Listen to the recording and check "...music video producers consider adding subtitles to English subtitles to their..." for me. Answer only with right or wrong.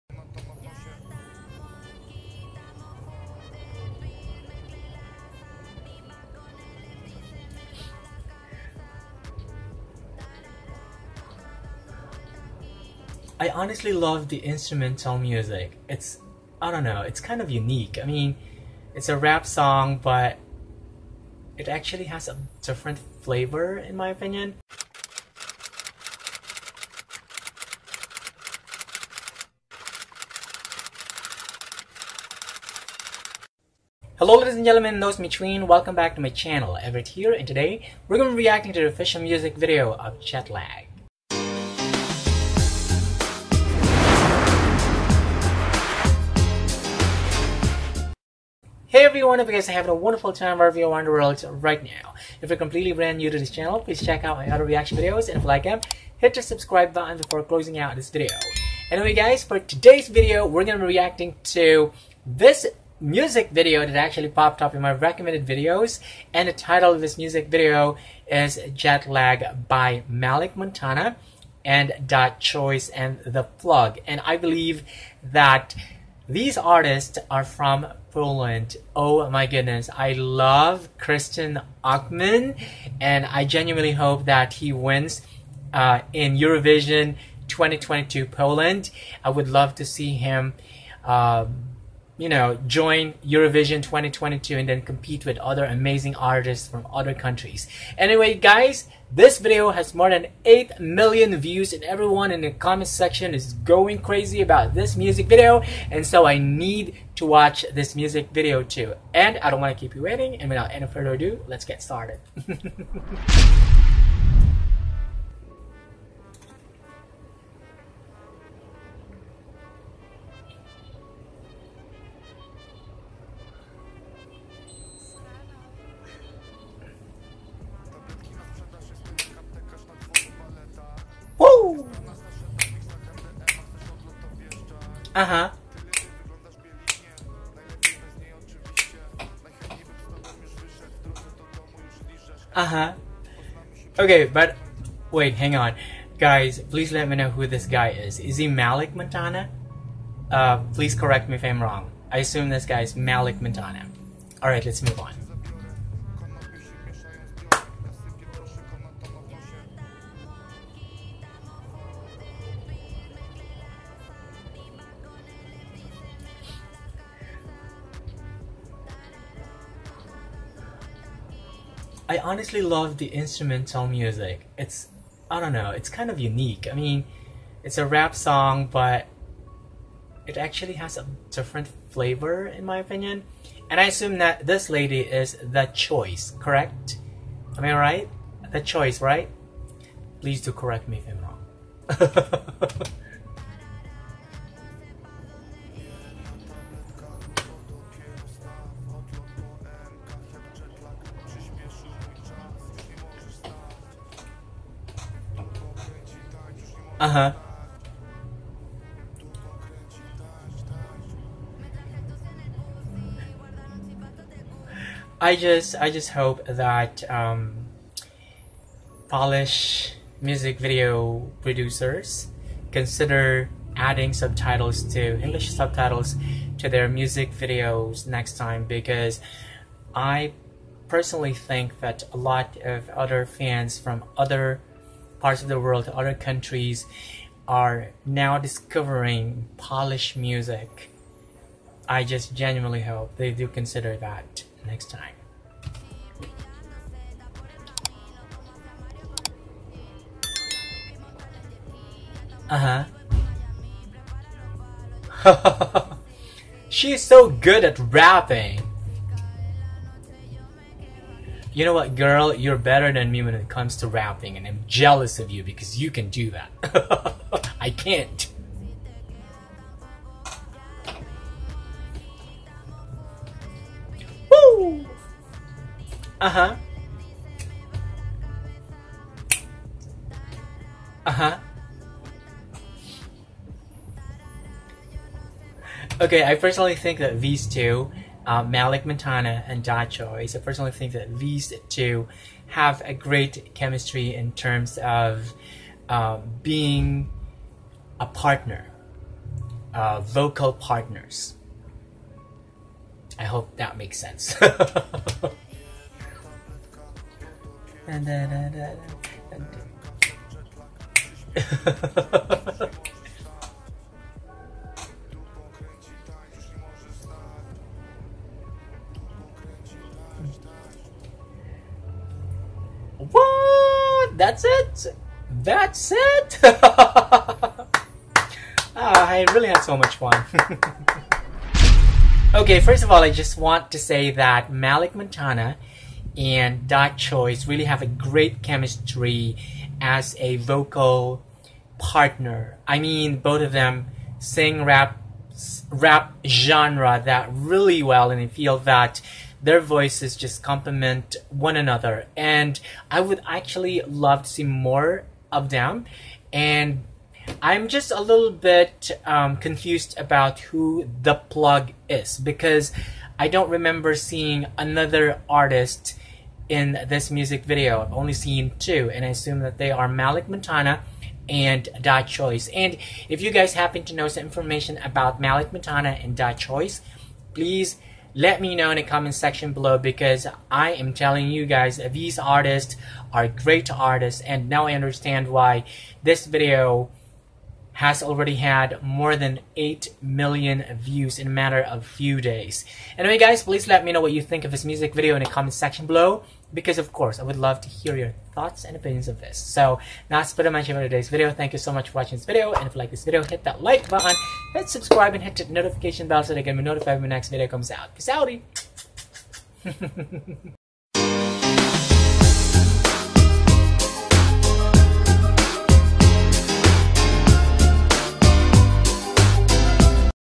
right.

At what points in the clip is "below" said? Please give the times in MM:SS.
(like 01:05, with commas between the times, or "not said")
06:19, 06:35.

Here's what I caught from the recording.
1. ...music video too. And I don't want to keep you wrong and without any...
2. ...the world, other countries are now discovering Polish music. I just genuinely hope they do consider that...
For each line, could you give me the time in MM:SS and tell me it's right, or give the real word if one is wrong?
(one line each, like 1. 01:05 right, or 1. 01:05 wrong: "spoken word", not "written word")
1. 01:47 wrong: "waiting", not "wrong"
2. 03:55 right.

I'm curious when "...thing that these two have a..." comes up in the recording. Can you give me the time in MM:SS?
04:50.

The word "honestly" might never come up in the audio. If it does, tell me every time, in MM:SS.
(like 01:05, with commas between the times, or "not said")
00:13, 02:52.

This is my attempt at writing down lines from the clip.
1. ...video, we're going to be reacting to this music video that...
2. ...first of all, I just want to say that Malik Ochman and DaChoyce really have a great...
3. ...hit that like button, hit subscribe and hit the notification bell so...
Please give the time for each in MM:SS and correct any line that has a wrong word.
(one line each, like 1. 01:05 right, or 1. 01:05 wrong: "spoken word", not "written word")
1. 01:00 right
2. 05:32 wrong: "Montana", not "Ochman"
3. 06:43 right.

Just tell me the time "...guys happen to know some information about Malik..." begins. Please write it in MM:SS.
06:13.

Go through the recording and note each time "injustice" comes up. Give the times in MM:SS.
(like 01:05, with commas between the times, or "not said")
not said.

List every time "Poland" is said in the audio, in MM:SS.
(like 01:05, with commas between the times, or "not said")
01:18, 01:28.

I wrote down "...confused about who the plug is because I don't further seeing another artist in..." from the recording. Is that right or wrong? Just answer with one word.
wrong.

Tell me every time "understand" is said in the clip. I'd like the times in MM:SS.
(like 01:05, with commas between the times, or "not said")
06:24.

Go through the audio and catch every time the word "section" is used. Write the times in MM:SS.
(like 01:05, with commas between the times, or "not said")
01:42, 06:19, 06:35.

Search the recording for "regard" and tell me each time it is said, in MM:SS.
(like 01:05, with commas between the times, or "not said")
not said.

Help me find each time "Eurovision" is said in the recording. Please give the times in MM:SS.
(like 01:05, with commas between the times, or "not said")
01:26, 01:33.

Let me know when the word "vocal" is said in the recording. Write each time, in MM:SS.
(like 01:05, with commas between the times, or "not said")
05:00, 05:40.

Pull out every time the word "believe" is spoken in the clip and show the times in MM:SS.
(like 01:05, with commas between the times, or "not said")
01:14.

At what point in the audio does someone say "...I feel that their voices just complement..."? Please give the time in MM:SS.
05:48.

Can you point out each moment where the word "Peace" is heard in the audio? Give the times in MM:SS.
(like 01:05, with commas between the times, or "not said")
06:47.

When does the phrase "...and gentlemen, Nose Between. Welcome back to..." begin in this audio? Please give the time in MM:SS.
00:34.